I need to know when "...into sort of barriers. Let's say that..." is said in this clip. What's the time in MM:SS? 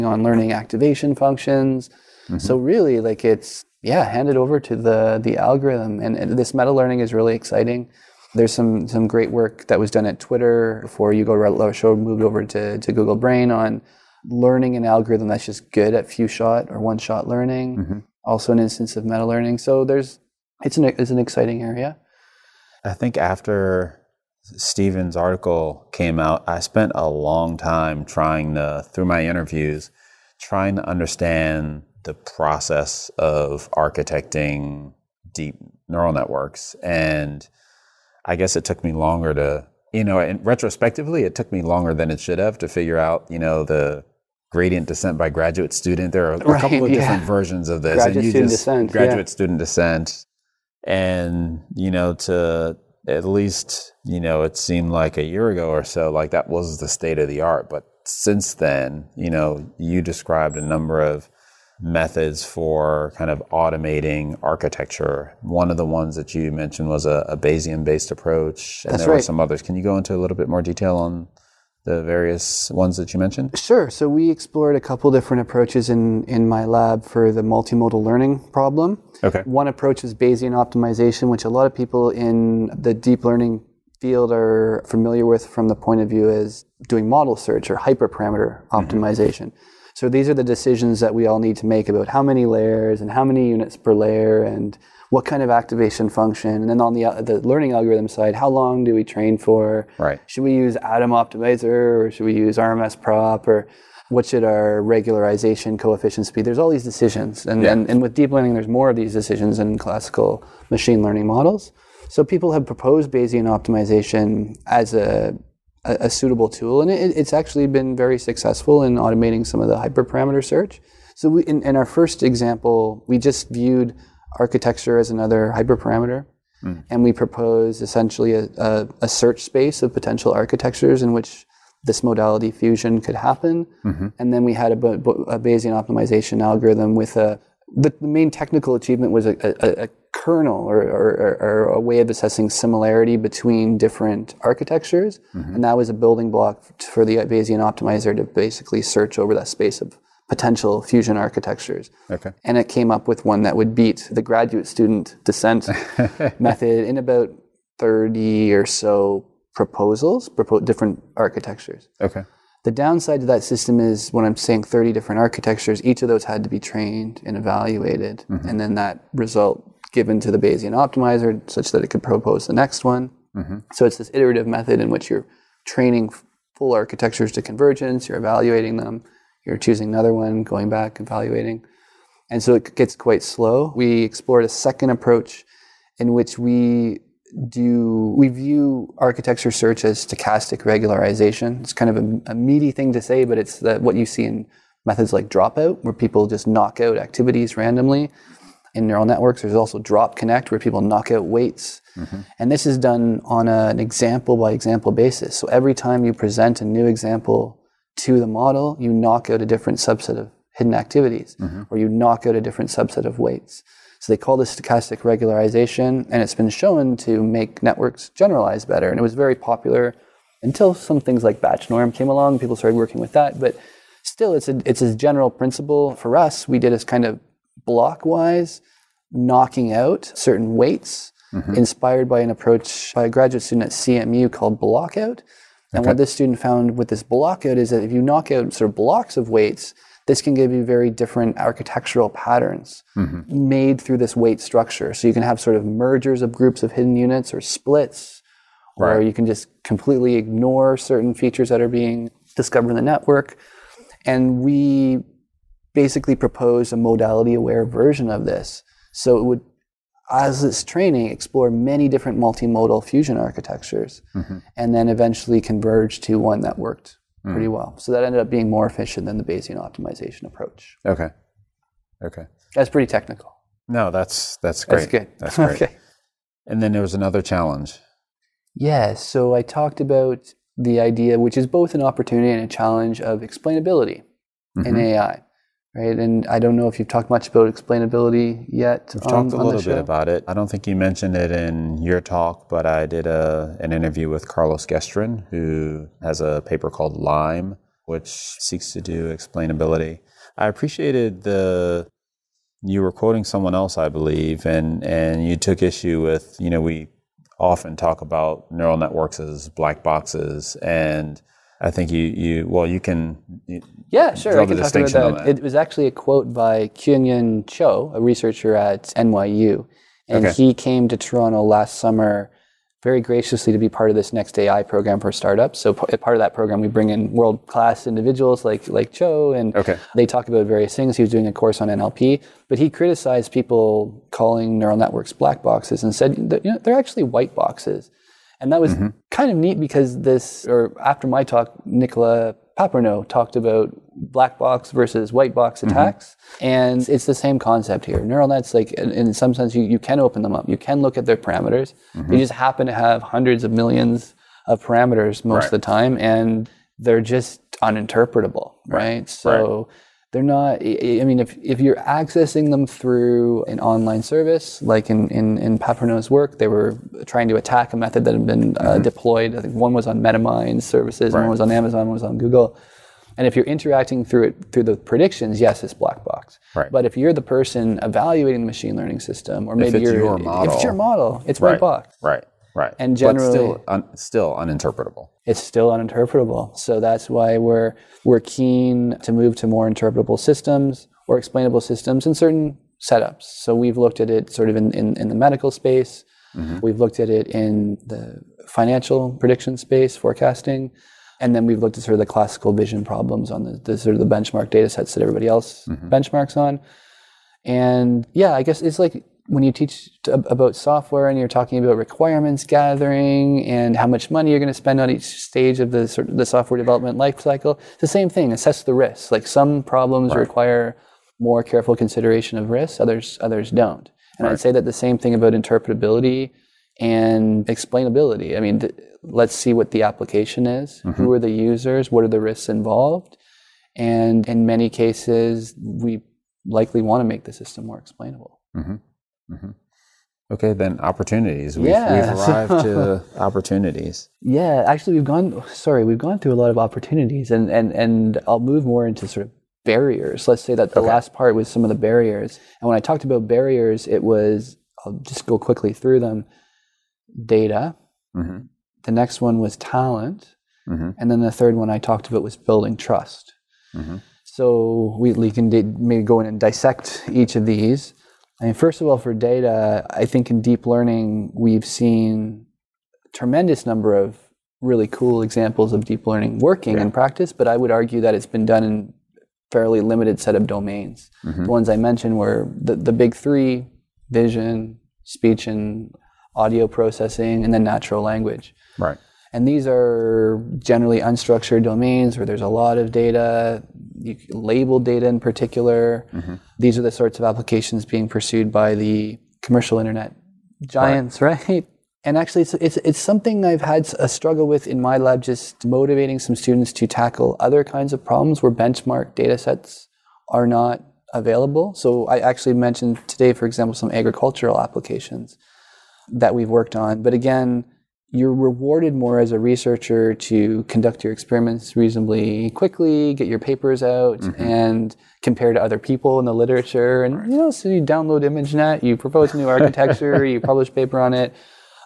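07:28.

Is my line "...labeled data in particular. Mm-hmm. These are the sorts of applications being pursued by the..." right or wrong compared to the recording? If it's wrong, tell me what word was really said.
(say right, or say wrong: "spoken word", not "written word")
right.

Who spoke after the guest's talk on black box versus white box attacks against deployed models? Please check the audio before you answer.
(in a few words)
Nicolas Papernot.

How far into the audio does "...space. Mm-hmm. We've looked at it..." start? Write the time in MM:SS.
06:35.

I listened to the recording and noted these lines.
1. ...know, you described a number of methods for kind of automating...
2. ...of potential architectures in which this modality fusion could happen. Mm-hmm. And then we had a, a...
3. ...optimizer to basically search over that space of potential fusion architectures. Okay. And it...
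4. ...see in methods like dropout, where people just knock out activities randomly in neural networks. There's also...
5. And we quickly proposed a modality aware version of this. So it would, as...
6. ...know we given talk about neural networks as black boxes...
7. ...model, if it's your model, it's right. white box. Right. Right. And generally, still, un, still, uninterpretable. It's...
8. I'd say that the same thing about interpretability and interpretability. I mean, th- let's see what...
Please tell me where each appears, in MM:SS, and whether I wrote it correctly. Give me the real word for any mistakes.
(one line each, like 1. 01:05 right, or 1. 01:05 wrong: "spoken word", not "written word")
1. 00:59 right
2. 02:09 right
3. 02:27 right
4. 03:14 right
5. 04:14 wrong: "basically", not "quickly"
6. 05:06 wrong: "often", not "given"
7. 06:20 right
8. 07:04 wrong: "explainability", not "interpretability".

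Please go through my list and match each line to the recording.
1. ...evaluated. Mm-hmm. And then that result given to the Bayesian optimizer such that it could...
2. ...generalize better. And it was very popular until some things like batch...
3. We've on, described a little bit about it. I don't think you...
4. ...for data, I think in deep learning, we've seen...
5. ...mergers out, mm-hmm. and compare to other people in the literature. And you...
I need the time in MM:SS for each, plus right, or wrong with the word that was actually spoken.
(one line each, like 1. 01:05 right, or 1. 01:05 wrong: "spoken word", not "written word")
1. 02:47 right
2. 03:38 right
3. 04:48 wrong: "talked", not "described"
4. 07:48 right
5. 08:43 wrong: "papers", not "mergers".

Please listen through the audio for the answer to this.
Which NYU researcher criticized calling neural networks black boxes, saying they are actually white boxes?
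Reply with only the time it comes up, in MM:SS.
05:16.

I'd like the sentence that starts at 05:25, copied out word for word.
So part of that program, we bring in world class individuals like like Cho, and okay.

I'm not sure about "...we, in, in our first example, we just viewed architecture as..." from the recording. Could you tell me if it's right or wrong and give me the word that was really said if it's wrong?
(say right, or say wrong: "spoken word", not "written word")
right.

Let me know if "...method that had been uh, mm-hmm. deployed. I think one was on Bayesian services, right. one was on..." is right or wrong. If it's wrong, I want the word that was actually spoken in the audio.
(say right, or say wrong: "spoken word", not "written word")
wrong: "MetaMind", not "Bayesian".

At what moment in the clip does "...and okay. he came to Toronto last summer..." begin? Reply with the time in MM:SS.
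05:20.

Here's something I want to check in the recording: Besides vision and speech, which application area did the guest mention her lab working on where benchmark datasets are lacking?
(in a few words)
agricultural applications.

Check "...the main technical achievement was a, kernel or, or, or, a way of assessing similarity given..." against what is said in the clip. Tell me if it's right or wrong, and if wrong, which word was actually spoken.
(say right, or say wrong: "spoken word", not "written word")
wrong: "between", not "given".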